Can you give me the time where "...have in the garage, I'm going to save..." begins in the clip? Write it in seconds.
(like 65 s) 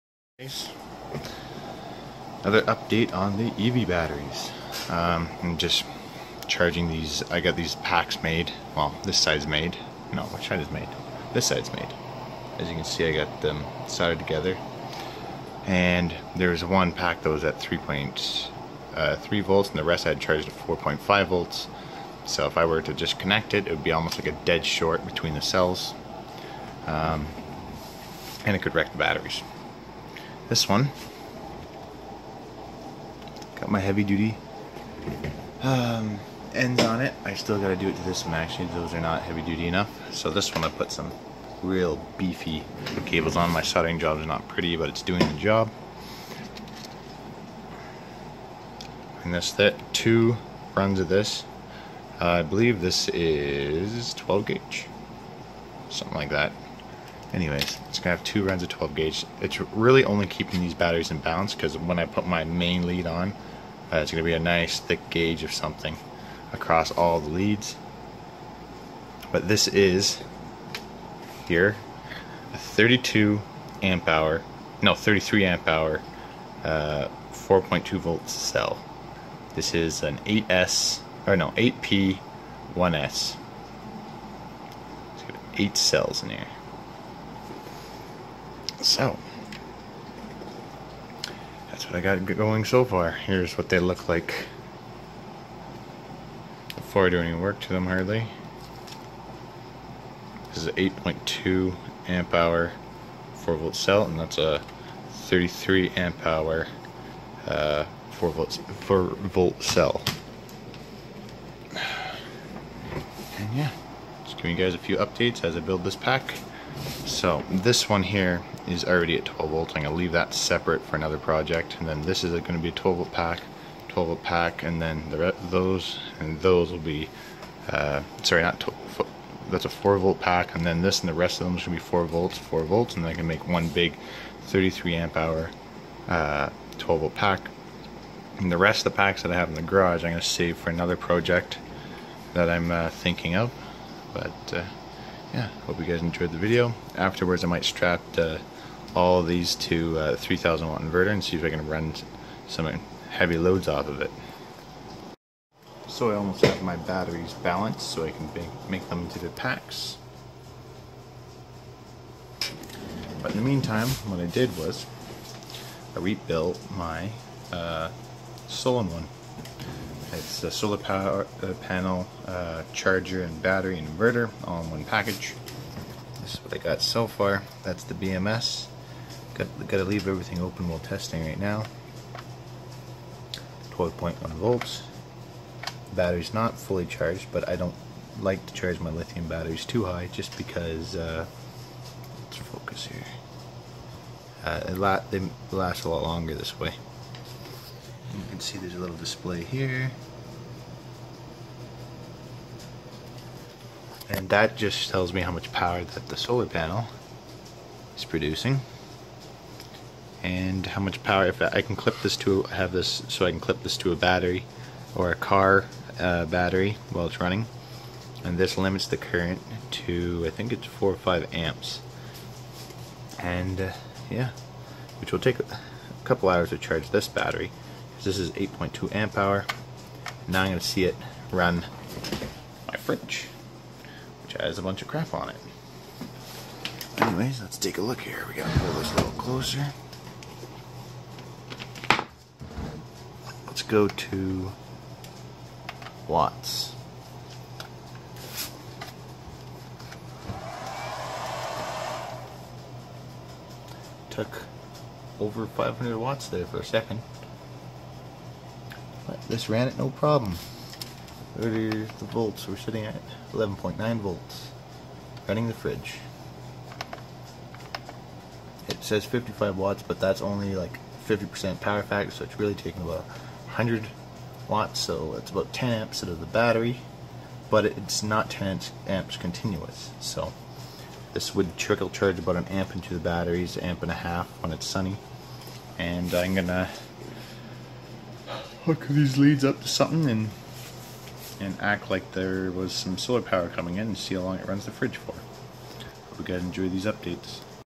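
139 s.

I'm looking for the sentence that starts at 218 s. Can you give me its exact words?
And this limits the current to, I think it's 4 or 5 amps.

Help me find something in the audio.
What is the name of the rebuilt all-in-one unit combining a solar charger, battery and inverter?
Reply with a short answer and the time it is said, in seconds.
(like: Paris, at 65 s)
Solon one, at 168 s.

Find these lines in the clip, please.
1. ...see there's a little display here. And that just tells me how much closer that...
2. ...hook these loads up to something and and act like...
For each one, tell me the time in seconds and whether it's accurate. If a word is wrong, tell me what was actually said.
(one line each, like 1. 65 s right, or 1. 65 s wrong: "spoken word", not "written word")
1. 198 s wrong: "power", not "closer"
2. 288 s wrong: "leads", not "loads".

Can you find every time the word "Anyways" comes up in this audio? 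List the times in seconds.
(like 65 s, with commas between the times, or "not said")
57 s, 236 s.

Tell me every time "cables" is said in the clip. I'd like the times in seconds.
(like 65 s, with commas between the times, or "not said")
43 s.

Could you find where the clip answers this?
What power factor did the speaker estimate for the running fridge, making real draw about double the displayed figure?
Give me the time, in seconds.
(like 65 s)
271 s.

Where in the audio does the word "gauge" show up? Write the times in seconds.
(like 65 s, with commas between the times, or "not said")
54 s, 58 s, 65 s.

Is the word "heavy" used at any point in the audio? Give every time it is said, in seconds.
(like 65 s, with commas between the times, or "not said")
33 s, 39 s, 153 s.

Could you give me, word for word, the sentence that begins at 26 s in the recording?
Um, and it could wreck the batteries this one.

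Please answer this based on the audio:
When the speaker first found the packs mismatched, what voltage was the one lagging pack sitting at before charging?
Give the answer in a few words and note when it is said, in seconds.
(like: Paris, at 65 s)
3.3 volts, at 17 s.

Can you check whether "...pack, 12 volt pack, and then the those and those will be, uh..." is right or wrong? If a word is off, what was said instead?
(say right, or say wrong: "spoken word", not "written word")
right.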